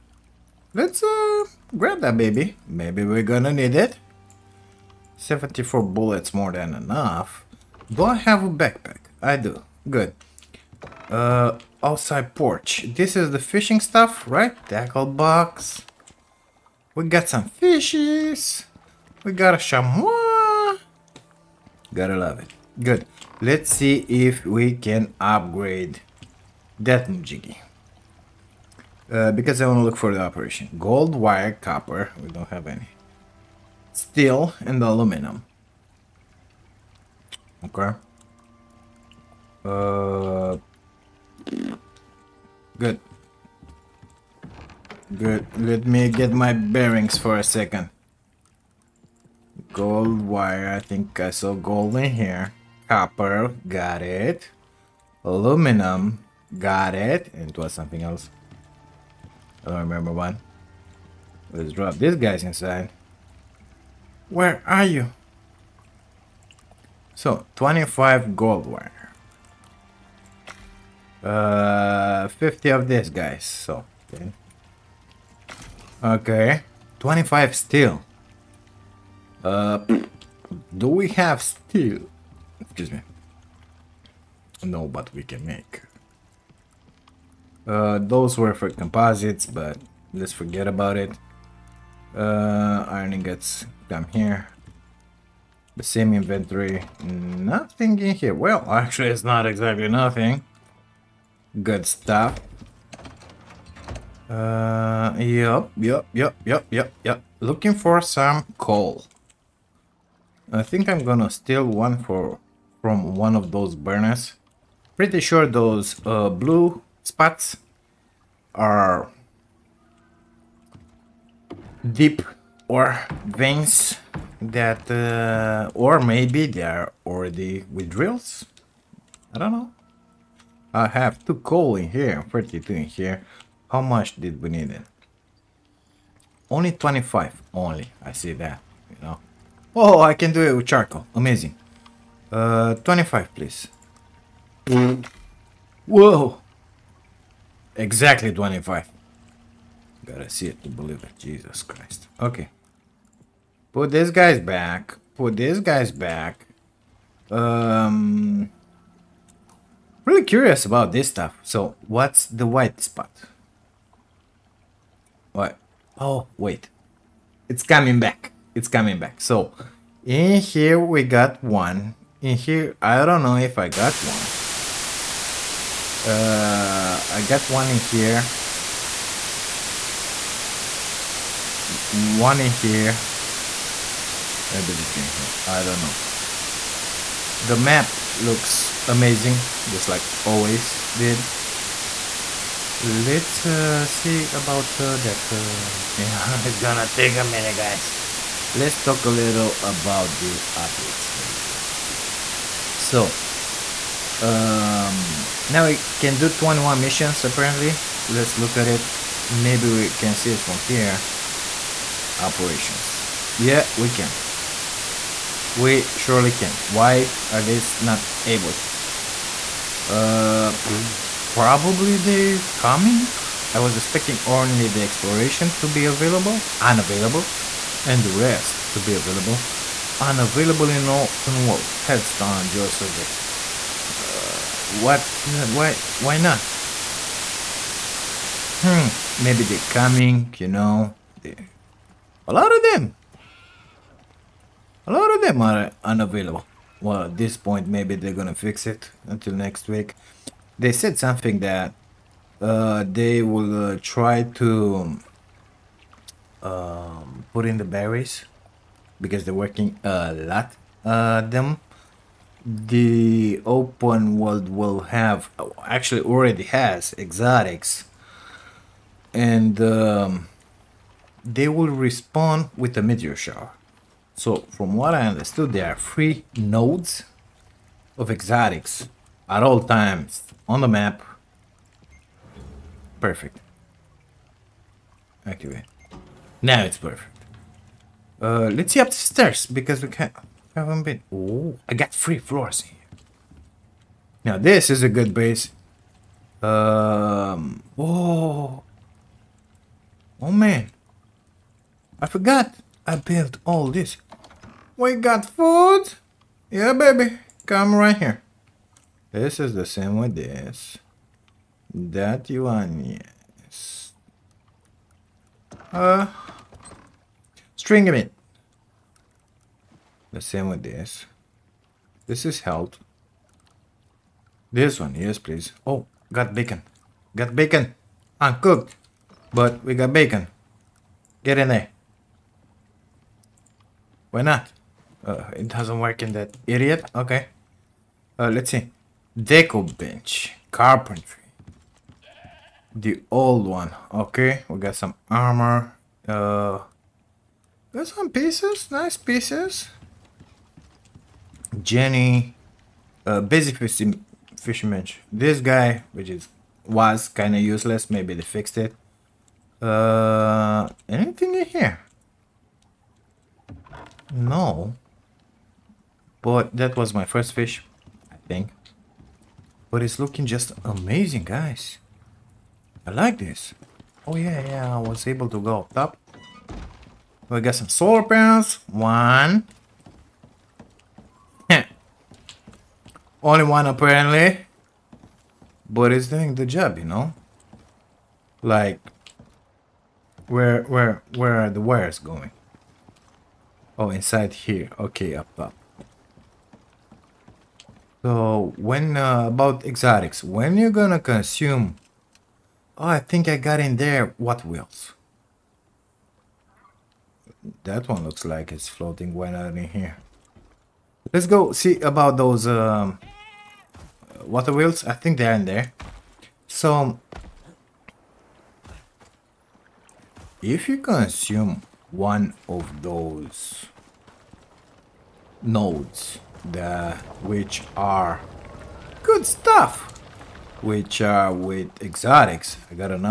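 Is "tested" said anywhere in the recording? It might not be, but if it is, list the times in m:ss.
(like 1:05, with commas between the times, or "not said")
not said.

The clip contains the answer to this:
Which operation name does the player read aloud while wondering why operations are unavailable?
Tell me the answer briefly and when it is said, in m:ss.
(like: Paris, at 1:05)
Headstone geosurvey, at 3:51.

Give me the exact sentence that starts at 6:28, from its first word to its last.
Like where where where are the wires going?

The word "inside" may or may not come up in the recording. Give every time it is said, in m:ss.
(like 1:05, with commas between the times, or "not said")
1:02, 6:33.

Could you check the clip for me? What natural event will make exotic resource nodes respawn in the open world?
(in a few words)
A meteor shower.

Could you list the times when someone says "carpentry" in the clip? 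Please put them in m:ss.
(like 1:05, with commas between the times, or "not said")
5:40.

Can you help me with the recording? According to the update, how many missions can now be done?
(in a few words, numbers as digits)
21.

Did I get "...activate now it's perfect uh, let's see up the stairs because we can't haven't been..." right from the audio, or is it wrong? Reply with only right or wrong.
right.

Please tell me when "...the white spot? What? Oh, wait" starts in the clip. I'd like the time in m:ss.
2:42.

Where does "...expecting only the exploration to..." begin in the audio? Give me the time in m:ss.
3:43.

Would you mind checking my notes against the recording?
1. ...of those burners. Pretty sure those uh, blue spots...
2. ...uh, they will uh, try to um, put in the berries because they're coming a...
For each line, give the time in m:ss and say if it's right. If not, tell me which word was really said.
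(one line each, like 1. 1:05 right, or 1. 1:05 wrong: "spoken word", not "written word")
1. 1:53 right
2. 4:12 wrong: "working", not "coming".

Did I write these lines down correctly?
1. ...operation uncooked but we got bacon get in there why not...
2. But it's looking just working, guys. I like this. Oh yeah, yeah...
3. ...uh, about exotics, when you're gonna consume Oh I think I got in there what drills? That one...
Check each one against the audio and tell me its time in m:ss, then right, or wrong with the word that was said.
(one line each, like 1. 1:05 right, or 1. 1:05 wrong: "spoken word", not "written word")
1. 5:27 wrong: "bacon", not "operation"
2. 6:09 wrong: "amazing", not "working"
3. 6:38 wrong: "wheels", not "drills".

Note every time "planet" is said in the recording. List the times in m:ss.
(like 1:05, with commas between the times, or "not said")
not said.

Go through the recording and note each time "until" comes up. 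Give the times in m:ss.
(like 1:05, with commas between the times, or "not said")
4:09.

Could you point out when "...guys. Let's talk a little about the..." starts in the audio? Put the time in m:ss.
3:17.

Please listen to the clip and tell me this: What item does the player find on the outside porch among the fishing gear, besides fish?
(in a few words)
Tackle box.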